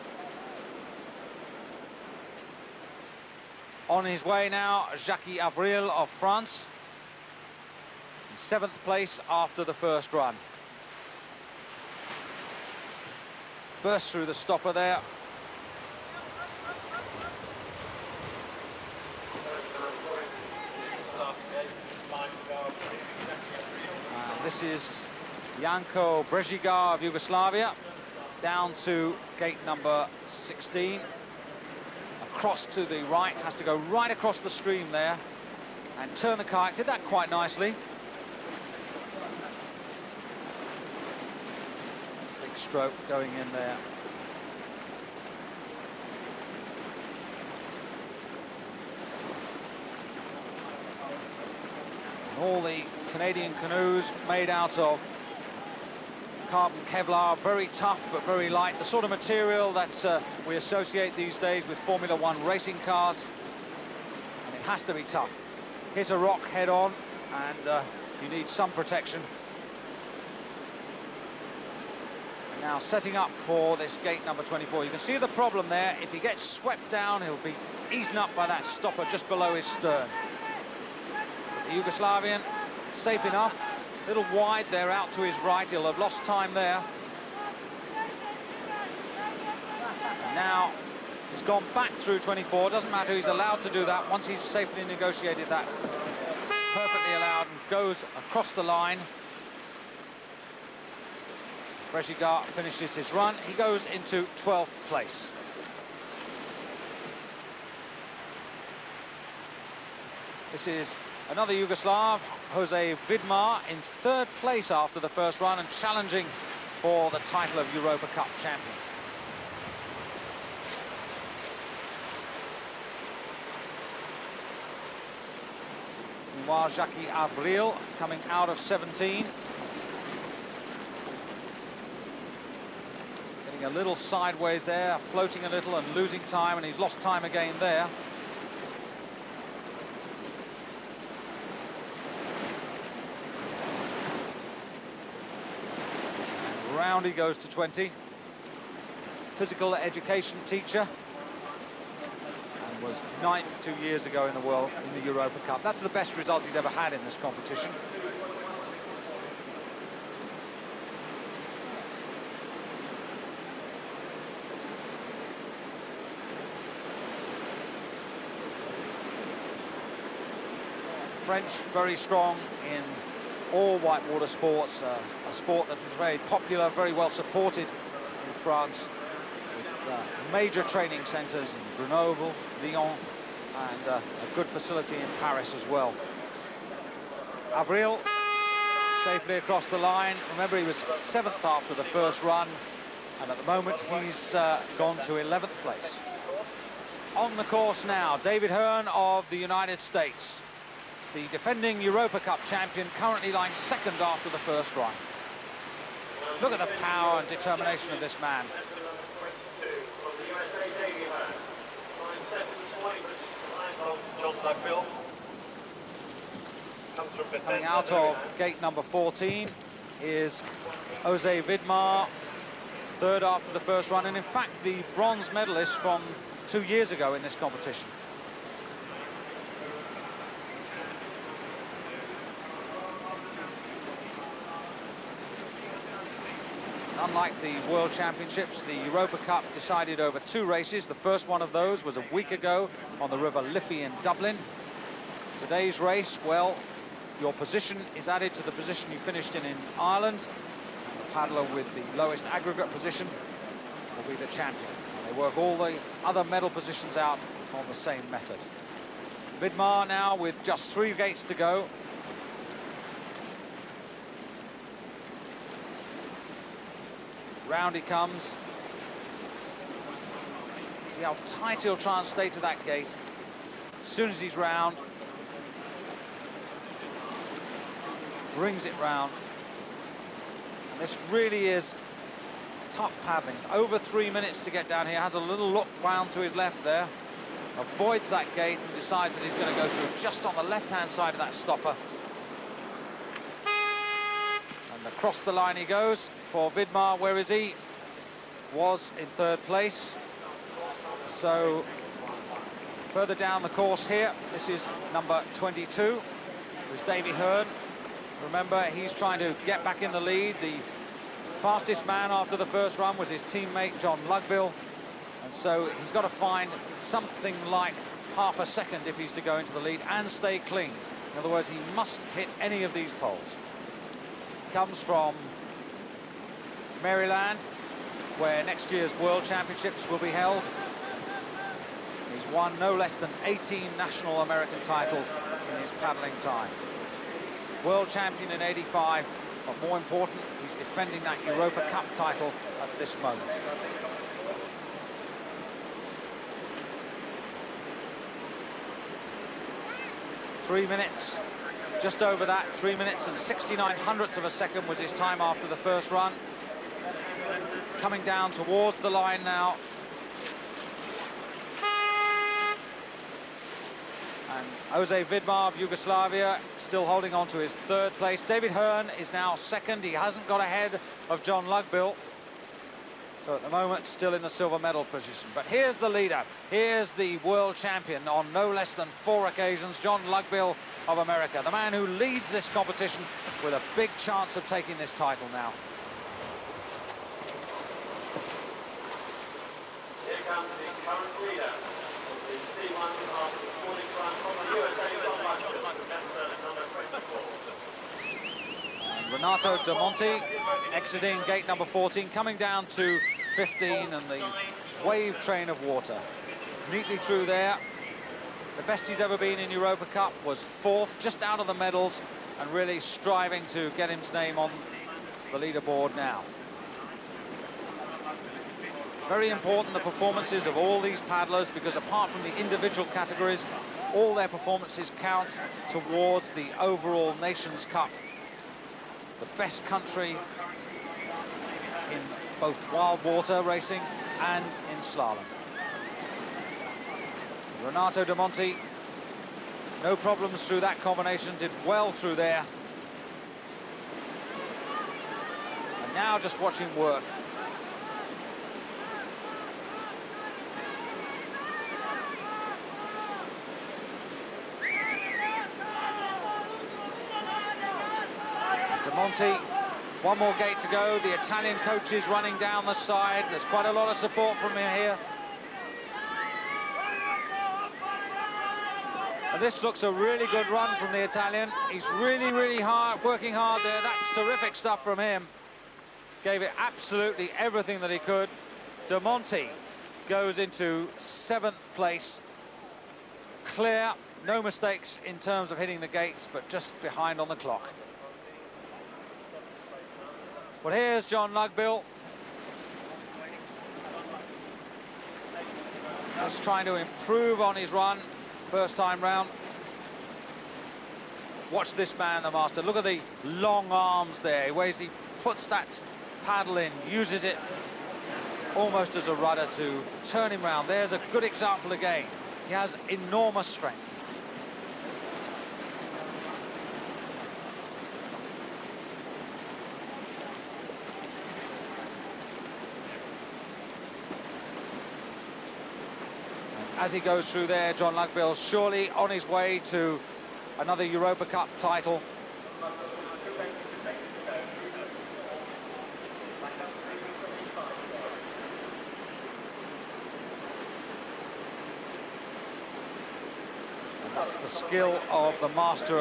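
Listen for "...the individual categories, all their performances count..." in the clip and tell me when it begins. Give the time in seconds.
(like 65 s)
422 s.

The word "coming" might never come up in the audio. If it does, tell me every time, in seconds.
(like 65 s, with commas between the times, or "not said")
127 s, 217 s, 357 s, 402 s.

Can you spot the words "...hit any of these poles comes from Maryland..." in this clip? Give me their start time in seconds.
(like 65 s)
322 s.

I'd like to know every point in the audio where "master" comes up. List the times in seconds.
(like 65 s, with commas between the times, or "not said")
502 s, 545 s.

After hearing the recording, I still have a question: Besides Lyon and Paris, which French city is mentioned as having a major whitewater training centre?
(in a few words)
Grenoble.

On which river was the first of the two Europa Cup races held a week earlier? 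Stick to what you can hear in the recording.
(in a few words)
River Liffey.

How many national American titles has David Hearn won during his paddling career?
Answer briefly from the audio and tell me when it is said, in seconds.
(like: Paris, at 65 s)
18, at 333 s.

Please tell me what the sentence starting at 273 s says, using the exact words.
As soon as he's round, brings it round.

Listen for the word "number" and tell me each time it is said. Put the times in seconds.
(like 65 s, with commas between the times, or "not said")
29 s, 74 s, 218 s, 304 s, 401 s.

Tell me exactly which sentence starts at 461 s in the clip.
The Italian coaches running down the side.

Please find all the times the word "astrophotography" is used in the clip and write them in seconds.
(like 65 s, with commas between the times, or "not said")
not said.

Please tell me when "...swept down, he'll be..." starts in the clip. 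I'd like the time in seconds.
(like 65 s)
76 s.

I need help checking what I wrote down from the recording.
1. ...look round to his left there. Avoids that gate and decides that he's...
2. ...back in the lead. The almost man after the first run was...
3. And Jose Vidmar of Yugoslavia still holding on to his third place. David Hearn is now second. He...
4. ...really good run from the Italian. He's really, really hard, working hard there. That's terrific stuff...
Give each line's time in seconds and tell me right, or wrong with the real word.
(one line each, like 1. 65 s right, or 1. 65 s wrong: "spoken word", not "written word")
1. 285 s right
2. 309 s wrong: "fastest", not "almost"
3. 364 s right
4. 469 s right.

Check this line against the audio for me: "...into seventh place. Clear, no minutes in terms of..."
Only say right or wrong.
wrong.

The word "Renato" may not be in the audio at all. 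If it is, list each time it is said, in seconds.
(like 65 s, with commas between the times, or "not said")
399 s, 437 s.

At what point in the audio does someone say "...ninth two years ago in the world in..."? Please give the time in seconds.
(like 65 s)
153 s.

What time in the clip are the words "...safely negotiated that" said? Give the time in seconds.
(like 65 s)
94 s.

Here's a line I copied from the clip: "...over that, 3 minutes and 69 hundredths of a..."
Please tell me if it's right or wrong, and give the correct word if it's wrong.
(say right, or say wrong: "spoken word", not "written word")
right.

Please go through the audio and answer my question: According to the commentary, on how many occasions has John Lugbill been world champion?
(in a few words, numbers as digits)
4.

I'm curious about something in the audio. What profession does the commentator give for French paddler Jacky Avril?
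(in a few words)
Physical education teacher.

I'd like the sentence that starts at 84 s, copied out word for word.
Little wide there out to his right.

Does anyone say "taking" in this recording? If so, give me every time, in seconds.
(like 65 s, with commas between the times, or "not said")
384 s.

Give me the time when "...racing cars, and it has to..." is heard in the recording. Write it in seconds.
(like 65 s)
62 s.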